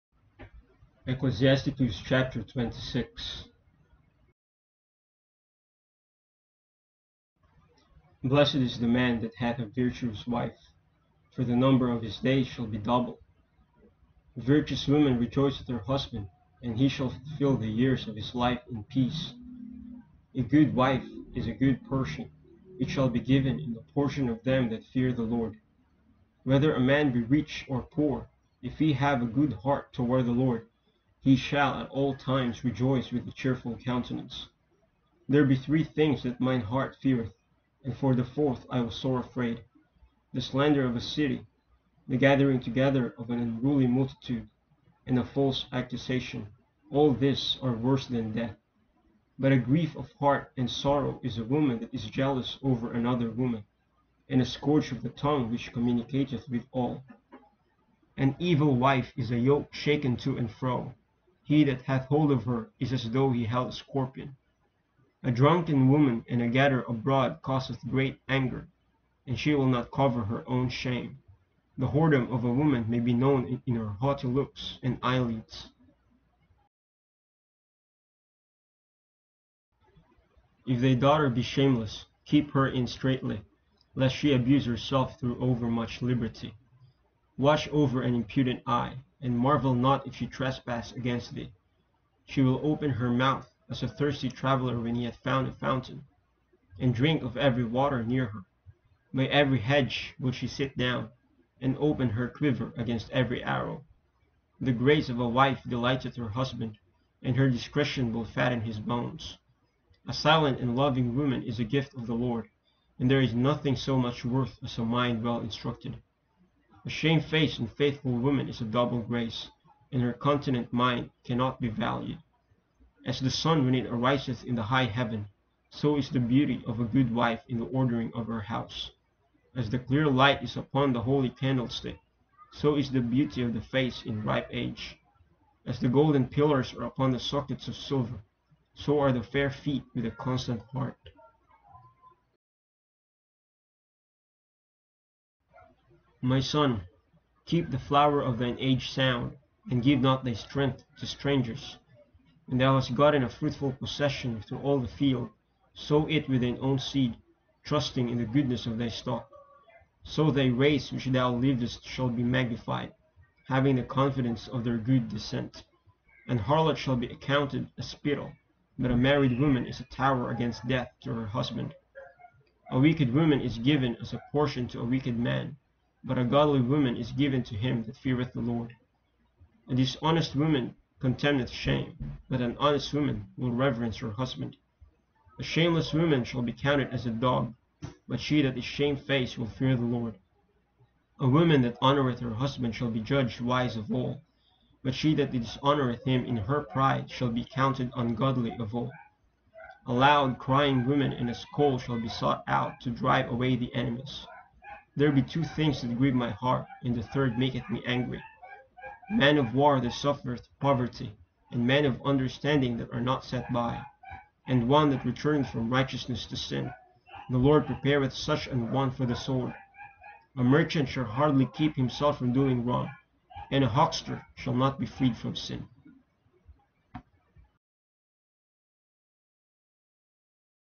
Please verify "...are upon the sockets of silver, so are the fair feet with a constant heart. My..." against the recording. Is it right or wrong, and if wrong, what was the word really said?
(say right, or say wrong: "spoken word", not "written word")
right.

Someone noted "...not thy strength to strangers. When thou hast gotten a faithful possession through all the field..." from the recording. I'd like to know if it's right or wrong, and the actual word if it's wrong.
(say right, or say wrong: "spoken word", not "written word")
wrong: "fruitful", not "faithful".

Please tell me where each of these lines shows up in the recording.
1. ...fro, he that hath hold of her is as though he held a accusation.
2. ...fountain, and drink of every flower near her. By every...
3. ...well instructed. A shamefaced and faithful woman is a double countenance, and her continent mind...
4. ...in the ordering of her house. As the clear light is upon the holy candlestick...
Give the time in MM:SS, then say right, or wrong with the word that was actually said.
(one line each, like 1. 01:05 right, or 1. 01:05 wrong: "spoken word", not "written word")
1. 01:00 wrong: "scorpion", not "accusation"
2. 01:35 wrong: "water", not "flower"
3. 01:55 wrong: "grace", not "countenance"
4. 02:07 right.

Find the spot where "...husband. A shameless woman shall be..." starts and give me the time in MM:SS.
03:04.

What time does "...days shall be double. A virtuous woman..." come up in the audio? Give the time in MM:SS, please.
00:12.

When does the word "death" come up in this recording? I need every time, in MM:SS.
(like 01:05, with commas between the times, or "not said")
00:48, 02:50.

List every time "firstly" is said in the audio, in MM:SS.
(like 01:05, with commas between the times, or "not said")
not said.